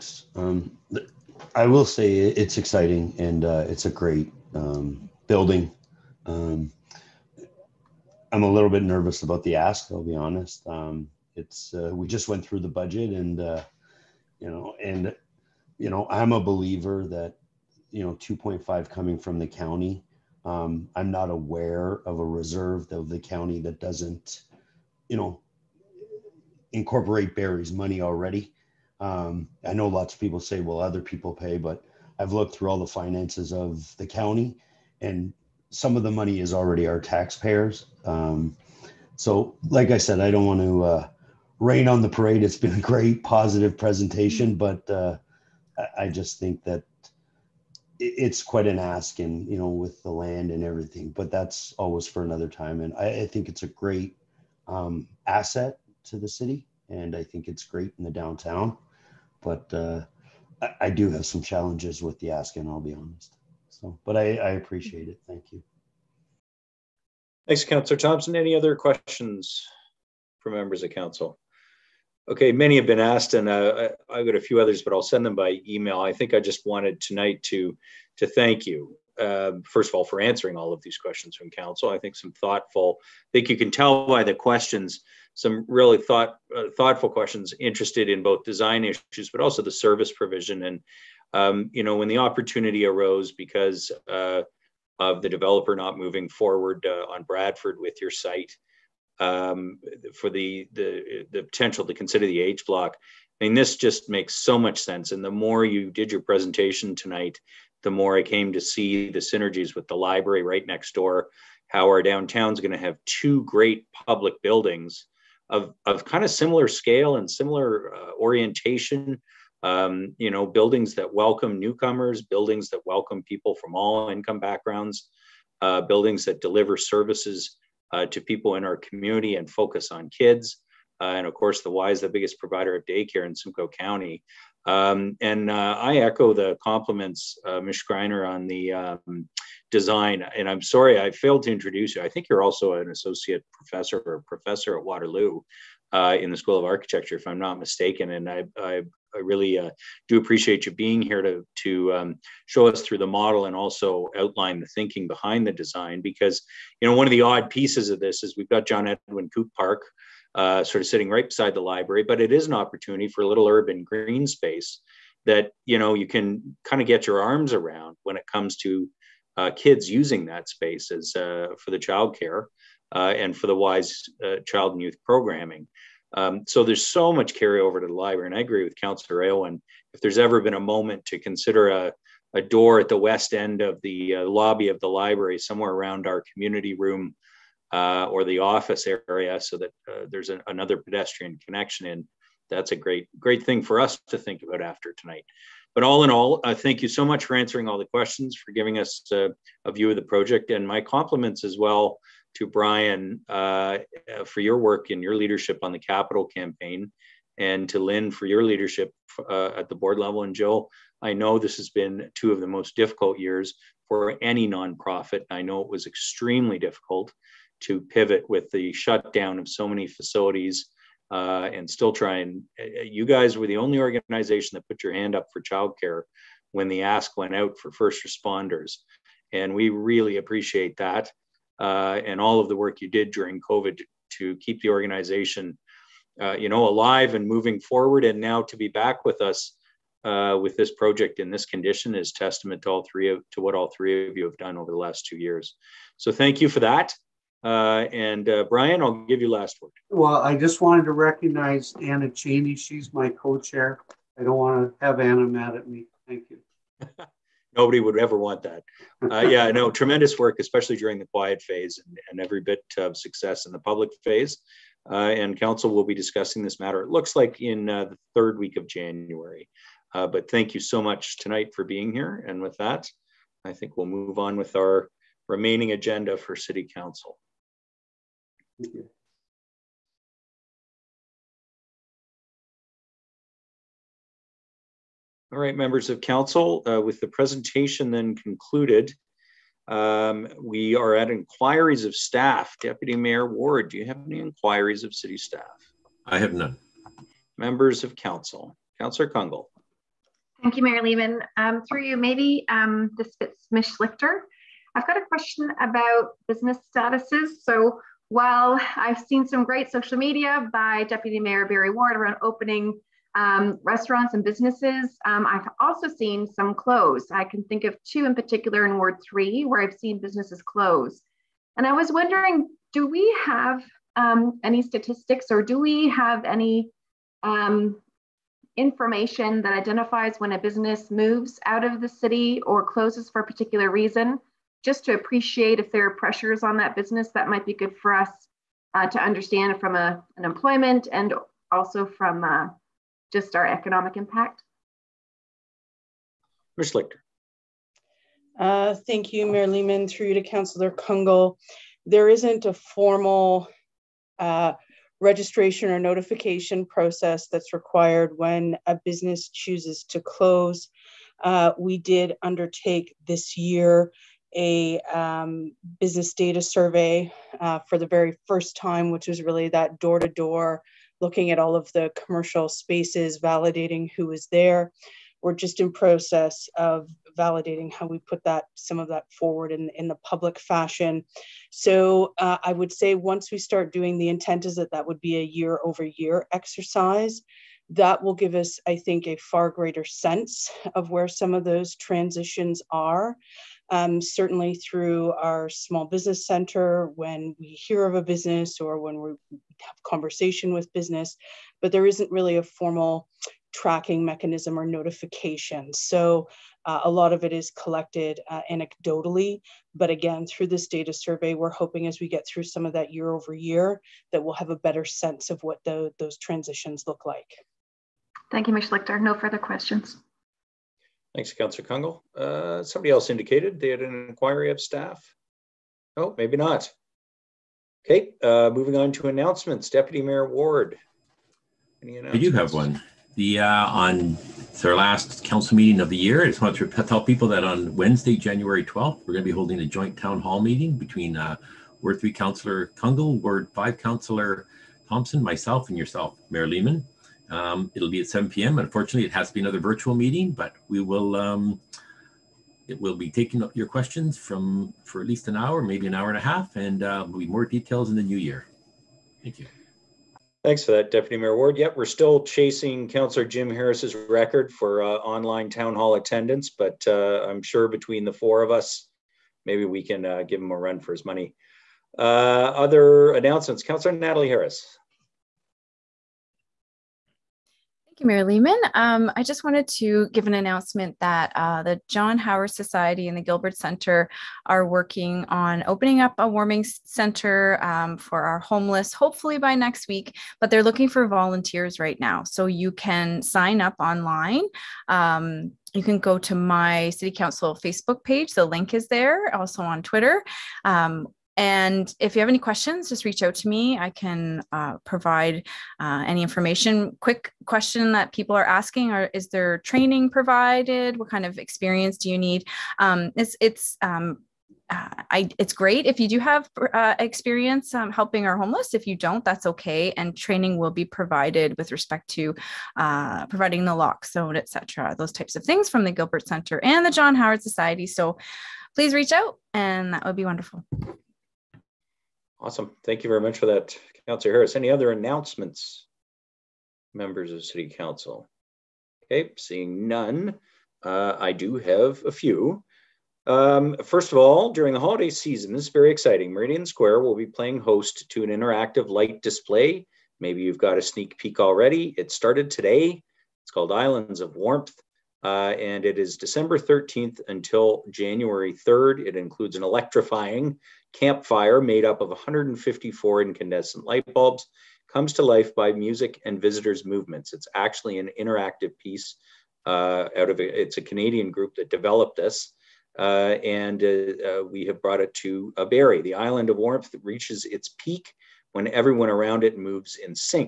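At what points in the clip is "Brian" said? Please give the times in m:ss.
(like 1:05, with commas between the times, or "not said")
3:22, 4:08.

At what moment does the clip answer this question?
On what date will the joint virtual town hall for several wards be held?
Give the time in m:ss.
7:18.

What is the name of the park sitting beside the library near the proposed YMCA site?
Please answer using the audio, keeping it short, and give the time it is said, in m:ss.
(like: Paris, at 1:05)
John Edwin Coop Park, at 2:38.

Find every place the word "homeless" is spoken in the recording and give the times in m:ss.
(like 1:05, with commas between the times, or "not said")
8:08, 8:38.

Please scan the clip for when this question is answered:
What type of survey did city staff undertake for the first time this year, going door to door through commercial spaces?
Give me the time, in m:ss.
6:05.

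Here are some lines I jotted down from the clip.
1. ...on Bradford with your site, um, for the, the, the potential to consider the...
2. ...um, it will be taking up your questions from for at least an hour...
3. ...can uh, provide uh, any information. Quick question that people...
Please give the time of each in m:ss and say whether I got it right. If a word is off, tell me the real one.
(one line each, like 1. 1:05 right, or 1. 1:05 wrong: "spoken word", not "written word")
1. 1:37 right
2. 7:31 right
3. 8:23 right.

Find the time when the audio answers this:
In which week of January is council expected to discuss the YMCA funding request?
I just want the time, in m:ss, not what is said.
4:27.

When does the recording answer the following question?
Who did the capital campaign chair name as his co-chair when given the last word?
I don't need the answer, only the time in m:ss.
4:11.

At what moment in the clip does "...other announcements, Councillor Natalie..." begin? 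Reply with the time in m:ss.
7:52.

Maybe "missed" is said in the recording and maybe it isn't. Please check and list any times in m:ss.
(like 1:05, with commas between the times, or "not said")
not said.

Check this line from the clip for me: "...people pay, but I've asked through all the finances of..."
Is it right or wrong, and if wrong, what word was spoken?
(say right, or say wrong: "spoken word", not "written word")
wrong: "looked", not "asked".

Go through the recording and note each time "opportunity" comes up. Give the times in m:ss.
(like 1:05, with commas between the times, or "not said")
1:32, 2:42.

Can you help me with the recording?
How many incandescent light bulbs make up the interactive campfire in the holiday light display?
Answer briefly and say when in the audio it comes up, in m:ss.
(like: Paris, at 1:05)
154, at 9:22.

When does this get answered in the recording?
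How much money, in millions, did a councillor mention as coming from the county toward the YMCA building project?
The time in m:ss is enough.
0:18.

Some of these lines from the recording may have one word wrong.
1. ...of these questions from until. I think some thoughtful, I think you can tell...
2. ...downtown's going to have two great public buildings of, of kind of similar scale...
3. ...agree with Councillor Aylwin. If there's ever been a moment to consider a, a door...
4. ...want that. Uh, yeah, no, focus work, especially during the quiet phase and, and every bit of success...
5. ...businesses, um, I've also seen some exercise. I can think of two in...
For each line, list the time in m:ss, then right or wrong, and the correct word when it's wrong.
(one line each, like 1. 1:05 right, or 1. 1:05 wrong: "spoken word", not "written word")
1. 1:20 wrong: "council", not "until"
2. 1:52 right
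3. 2:58 right
4. 4:18 wrong: "tremendous", not "focus"
5. 5:14 wrong: "close", not "exercise".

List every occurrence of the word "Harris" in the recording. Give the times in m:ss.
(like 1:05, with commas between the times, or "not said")
7:43, 7:54, 8:54.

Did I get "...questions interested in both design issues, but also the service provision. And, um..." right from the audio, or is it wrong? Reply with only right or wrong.
right.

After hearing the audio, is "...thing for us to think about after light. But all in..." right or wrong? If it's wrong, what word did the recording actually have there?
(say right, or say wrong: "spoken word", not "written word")
wrong: "tonight", not "light".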